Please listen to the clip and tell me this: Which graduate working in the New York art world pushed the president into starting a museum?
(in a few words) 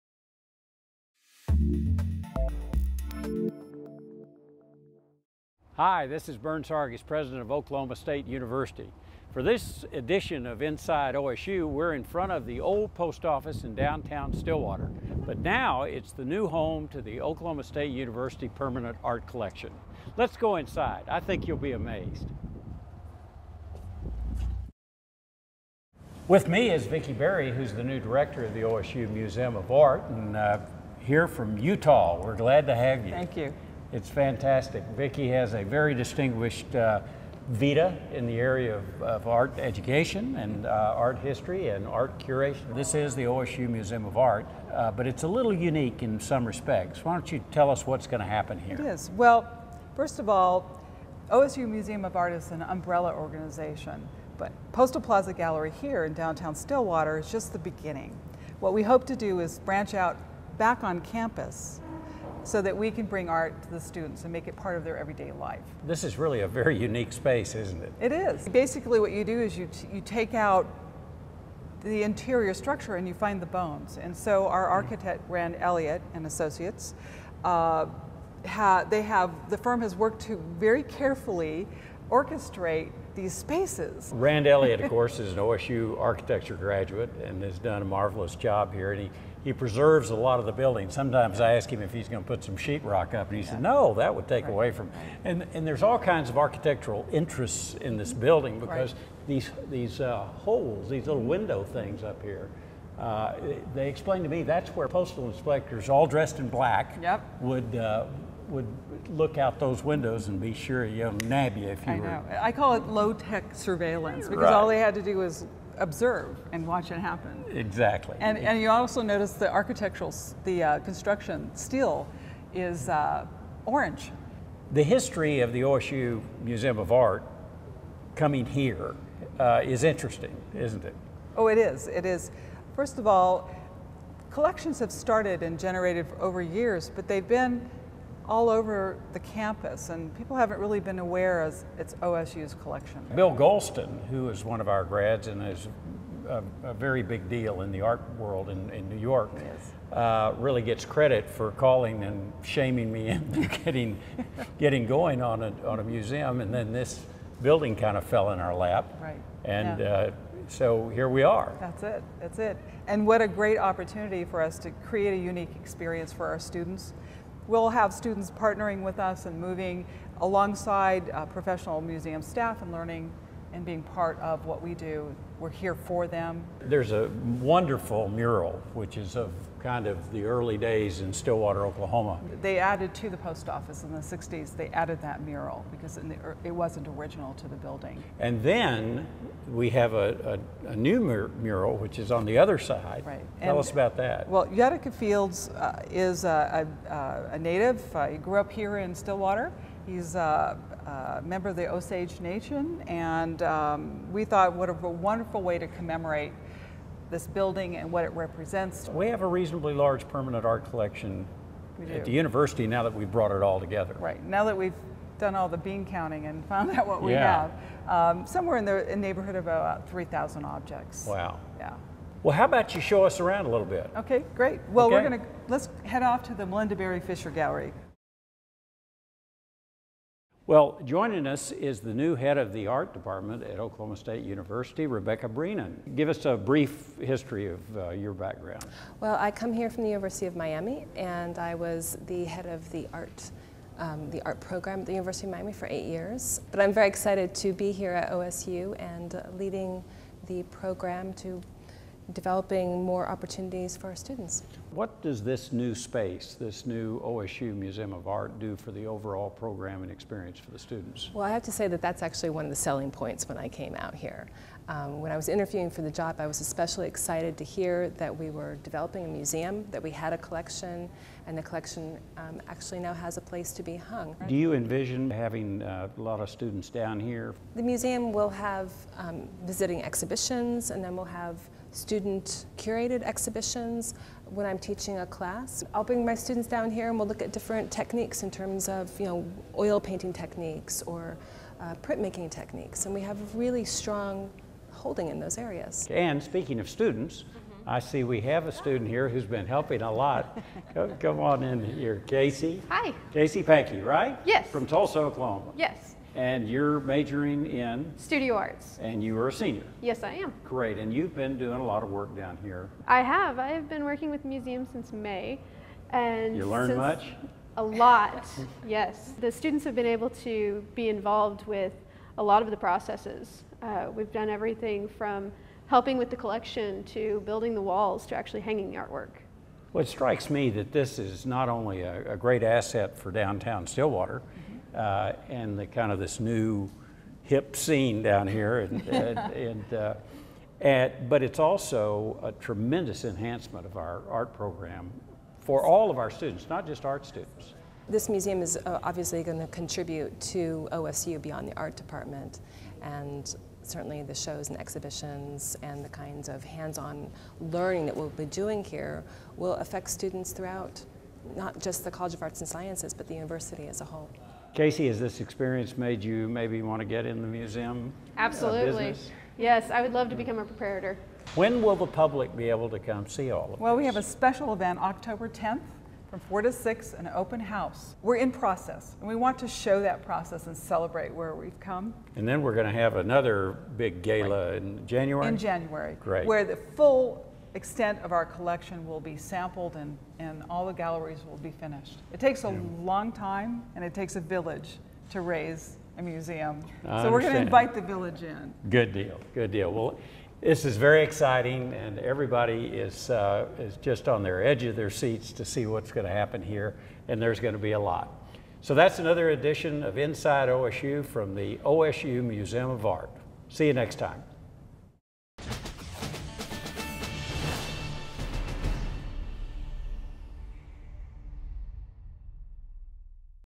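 Bill Goldston.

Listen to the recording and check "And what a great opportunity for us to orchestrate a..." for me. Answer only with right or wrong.
wrong.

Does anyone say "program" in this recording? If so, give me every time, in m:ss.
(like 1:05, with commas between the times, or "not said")
4:04, 4:10, 4:19, 5:44.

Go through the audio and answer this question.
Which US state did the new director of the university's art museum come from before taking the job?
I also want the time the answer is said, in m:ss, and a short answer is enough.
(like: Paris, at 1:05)
Utah, at 0:31.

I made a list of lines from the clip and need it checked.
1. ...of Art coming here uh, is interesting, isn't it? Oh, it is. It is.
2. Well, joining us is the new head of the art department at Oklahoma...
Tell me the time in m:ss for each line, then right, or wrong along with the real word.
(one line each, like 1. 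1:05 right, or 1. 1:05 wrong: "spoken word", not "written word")
1. 2:06 right
2. 3:50 right.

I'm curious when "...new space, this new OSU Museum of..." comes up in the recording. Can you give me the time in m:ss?
4:15.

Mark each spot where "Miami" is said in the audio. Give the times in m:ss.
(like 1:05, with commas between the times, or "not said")
4:00, 4:05.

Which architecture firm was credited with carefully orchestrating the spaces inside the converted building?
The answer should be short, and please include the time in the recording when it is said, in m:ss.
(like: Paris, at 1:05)
Rand Elliott and Associates, at 1:15.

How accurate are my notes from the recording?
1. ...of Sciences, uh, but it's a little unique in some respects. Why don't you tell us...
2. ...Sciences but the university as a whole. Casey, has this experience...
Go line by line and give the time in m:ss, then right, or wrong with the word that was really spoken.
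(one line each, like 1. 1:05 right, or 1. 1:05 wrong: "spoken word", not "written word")
1. 0:44 wrong: "Art", not "Sciences"
2. 6:02 right.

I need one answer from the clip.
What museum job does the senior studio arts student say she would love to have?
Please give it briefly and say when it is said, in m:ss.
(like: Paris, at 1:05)
Preparator, at 6:10.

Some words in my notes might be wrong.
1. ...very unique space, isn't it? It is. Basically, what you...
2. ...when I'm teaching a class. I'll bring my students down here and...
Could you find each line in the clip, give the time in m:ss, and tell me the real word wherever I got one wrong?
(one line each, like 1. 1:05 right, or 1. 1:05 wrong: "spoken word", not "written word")
1. 1:06 right
2. 4:44 right.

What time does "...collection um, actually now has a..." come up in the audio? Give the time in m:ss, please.
4:31.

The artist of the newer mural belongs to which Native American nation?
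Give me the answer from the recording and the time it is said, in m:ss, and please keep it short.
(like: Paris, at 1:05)
Osage Nation, at 3:21.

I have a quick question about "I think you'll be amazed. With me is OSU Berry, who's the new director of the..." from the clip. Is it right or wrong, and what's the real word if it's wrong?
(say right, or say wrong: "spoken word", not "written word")
wrong: "Vicki", not "OSU".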